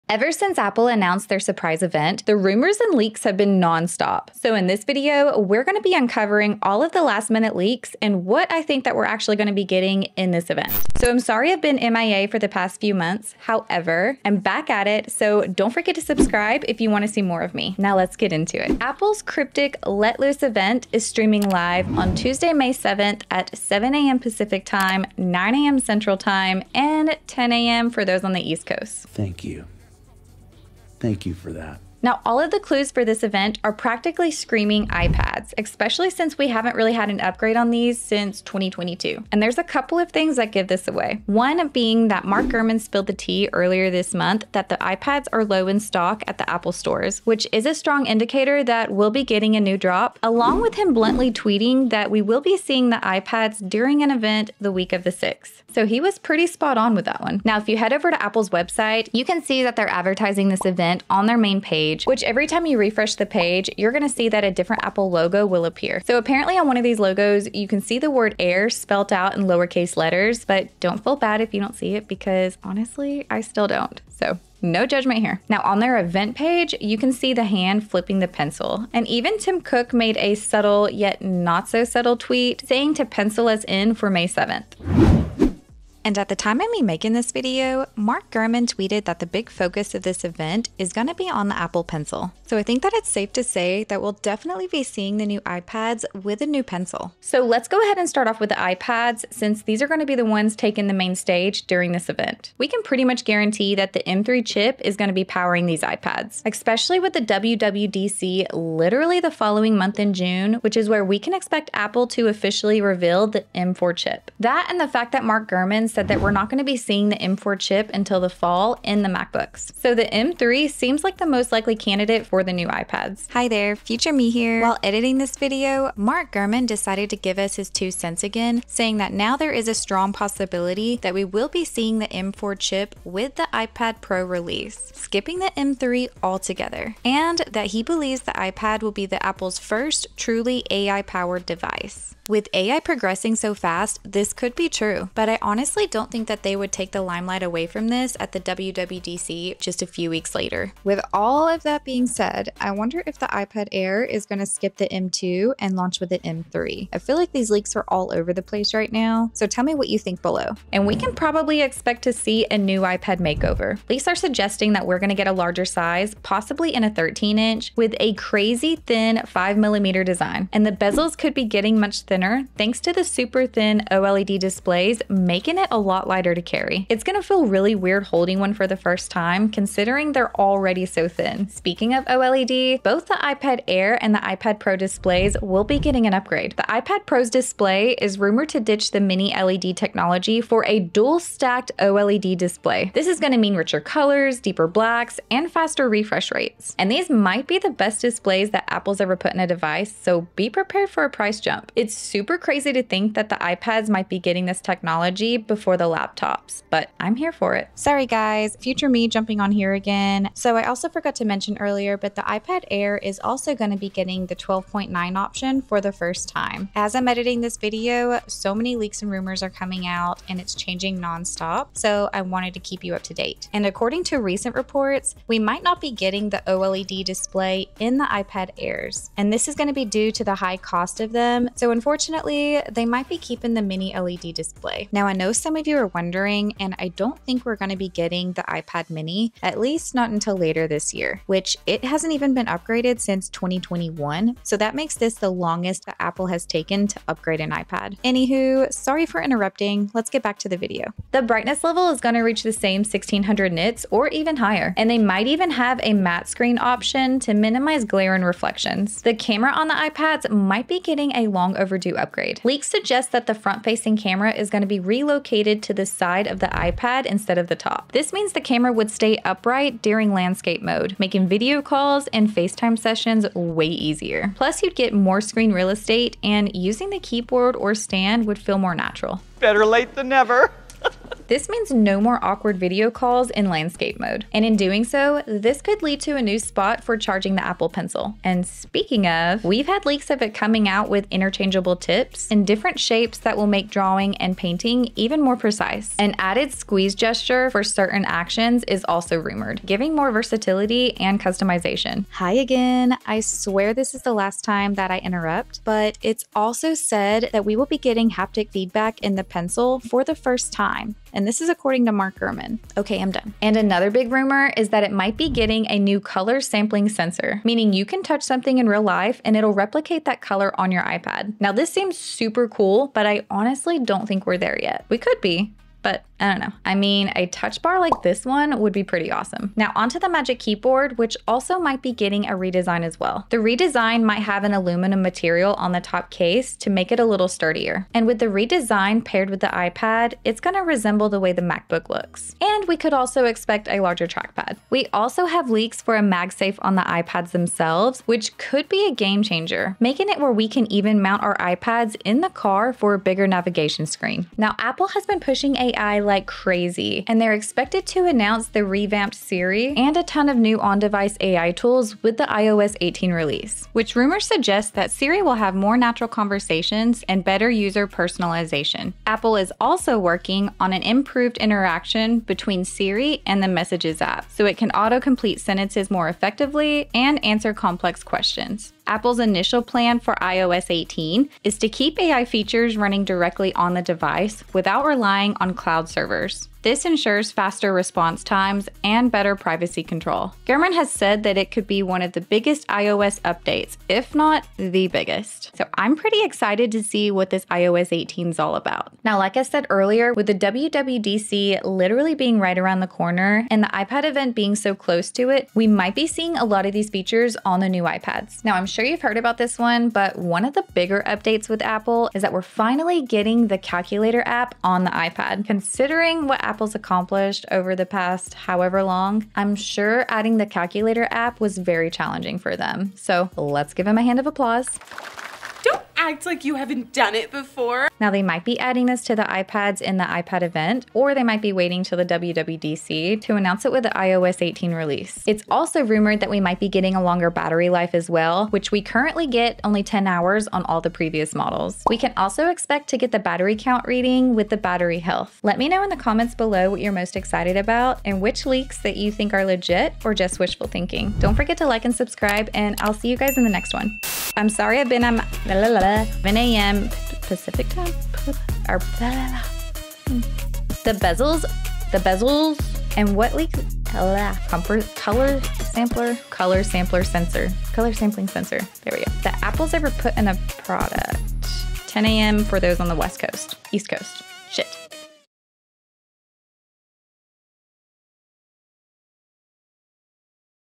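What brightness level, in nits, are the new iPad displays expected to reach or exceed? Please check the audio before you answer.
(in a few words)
1600 nits.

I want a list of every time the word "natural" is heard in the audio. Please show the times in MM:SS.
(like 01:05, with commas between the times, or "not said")
04:38, 06:05.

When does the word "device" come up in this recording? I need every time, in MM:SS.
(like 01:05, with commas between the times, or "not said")
02:21, 03:19, 06:00, 06:23.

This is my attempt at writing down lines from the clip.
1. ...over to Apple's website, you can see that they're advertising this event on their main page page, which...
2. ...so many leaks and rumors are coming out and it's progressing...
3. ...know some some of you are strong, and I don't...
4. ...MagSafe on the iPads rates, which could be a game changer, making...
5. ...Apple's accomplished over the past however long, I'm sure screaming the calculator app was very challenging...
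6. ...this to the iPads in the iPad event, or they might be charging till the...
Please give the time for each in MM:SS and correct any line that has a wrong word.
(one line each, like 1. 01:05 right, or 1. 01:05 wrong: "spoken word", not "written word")
1. 00:57 right
2. 03:38 wrong: "changing", not "progressing"
3. 03:55 wrong: "wondering", not "strong"
4. 05:46 wrong: "themselves", not "rates"
5. 06:56 wrong: "adding", not "screaming"
6. 07:08 wrong: "waiting", not "charging".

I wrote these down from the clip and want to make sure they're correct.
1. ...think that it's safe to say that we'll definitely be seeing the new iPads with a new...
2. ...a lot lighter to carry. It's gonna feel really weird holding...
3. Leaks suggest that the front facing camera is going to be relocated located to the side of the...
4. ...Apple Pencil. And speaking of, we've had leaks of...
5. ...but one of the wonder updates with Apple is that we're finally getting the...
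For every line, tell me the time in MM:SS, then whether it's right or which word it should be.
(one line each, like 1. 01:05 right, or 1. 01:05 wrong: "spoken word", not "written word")
1. 01:32 right
2. 02:55 right
3. 04:22 right
4. 04:47 right
5. 06:49 wrong: "bigger", not "wonder".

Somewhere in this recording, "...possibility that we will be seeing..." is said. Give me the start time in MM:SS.
02:10.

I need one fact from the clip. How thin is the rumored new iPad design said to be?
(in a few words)
5 millimeters.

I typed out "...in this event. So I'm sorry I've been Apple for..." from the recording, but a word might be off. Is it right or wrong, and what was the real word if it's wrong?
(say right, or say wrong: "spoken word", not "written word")
wrong: "MIA", not "Apple".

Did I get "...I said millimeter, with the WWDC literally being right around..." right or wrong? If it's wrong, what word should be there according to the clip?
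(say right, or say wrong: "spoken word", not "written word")
wrong: "earlier", not "millimeter".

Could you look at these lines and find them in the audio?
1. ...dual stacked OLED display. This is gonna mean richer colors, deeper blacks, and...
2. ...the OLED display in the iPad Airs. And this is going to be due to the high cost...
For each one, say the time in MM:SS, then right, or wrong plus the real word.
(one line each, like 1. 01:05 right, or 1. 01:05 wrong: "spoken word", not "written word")
1. 03:10 right
2. 03:46 right.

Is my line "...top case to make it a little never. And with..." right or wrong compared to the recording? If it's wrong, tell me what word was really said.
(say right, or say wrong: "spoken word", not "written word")
wrong: "sturdier", not "never".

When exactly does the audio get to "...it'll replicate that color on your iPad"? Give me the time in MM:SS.
05:19.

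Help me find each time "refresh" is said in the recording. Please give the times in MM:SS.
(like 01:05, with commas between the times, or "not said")
01:02, 03:15.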